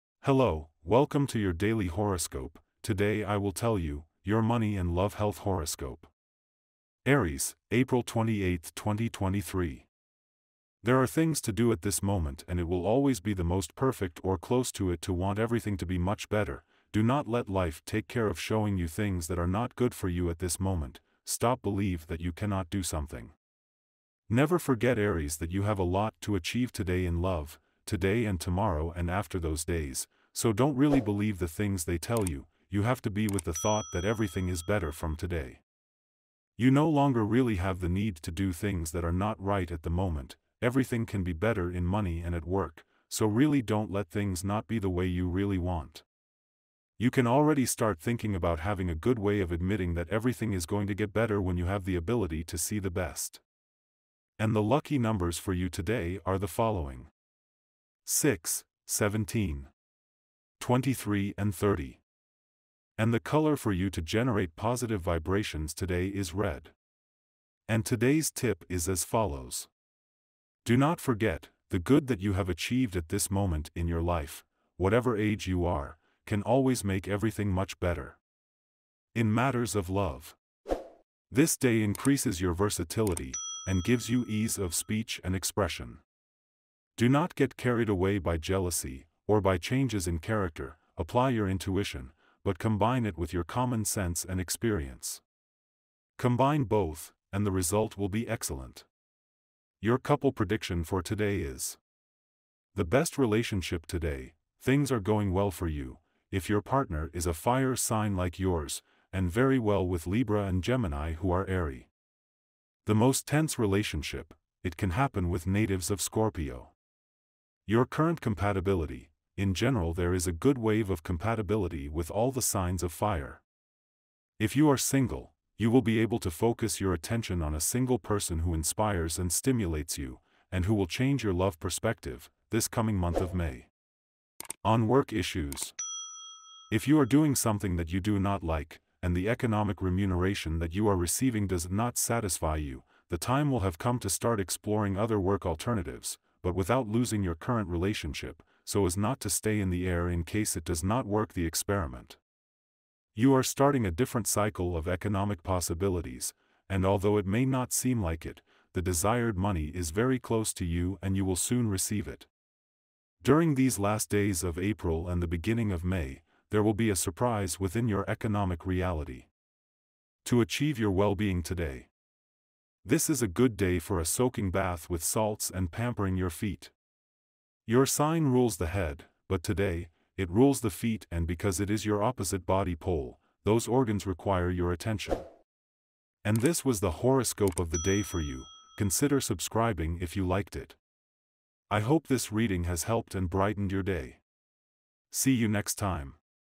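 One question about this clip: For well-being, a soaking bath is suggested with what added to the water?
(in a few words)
Salts.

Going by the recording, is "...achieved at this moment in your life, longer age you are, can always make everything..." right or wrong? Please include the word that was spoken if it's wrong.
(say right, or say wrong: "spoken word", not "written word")
wrong: "whatever", not "longer".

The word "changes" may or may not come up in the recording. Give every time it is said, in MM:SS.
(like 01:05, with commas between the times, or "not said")
01:29, 02:10.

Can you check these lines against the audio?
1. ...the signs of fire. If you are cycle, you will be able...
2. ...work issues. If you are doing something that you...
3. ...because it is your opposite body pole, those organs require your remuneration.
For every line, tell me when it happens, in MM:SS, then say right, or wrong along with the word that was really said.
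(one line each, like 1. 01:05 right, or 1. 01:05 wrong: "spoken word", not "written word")
1. 02:02 wrong: "single", not "cycle"
2. 02:14 right
3. 03:01 wrong: "attention", not "remuneration".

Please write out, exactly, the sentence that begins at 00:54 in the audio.
And the lucky numbers for you today are the following.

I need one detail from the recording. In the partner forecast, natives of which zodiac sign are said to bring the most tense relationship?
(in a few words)
Scorpio.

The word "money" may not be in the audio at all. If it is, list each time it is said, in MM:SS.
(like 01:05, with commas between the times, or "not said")
00:04, 00:41, 02:39.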